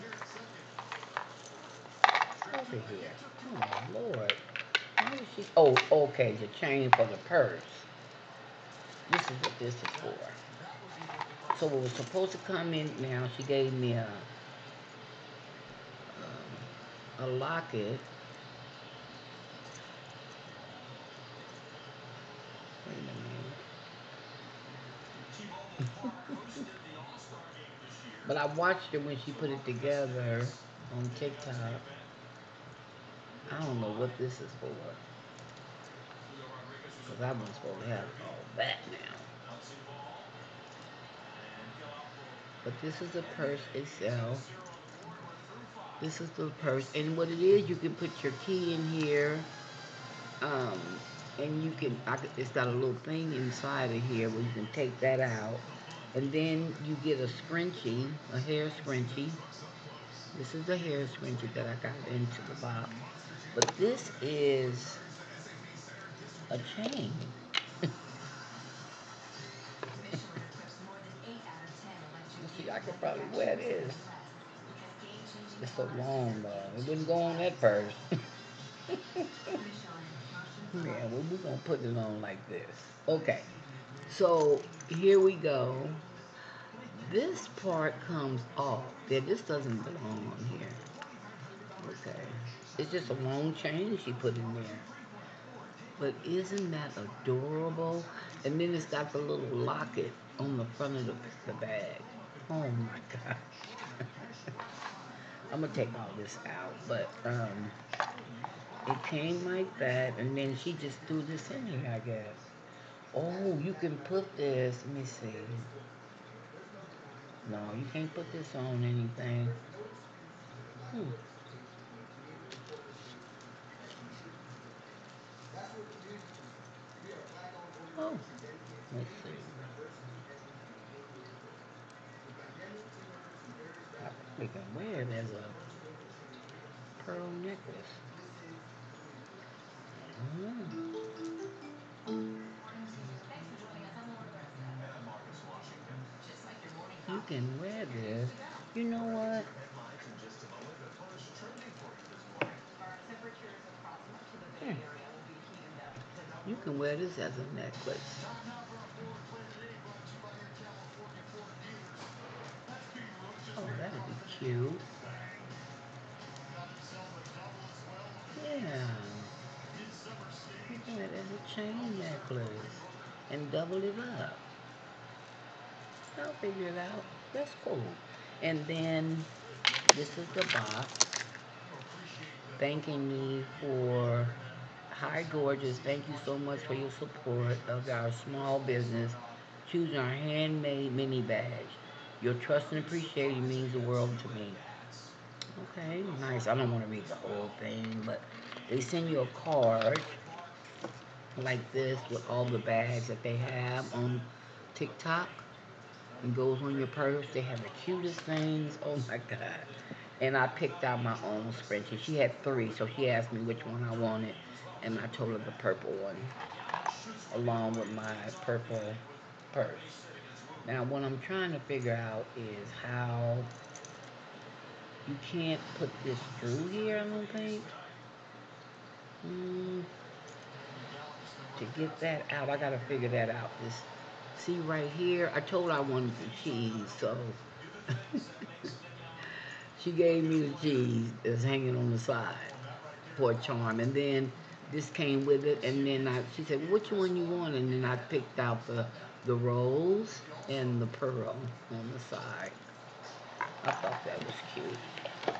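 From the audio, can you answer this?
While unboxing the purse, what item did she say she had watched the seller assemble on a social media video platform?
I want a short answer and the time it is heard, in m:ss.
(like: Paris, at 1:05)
a locket, at 0:17.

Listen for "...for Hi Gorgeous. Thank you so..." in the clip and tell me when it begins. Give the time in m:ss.
3:03.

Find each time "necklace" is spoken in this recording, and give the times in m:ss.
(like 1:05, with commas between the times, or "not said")
2:17, 2:37, 2:51.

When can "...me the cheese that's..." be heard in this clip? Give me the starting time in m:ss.
4:00.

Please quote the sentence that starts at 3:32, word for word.
She had three, so she asked me which one I wanted.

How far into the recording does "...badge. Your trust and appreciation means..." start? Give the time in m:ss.
3:11.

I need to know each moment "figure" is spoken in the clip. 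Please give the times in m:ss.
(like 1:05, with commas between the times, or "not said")
2:56, 3:41, 3:52.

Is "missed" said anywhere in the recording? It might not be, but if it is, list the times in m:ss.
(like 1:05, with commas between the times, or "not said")
not said.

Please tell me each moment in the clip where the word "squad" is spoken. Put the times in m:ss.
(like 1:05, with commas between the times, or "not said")
not said.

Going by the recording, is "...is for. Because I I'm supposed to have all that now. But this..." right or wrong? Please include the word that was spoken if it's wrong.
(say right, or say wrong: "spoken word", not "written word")
right.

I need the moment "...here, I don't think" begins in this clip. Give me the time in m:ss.
3:46.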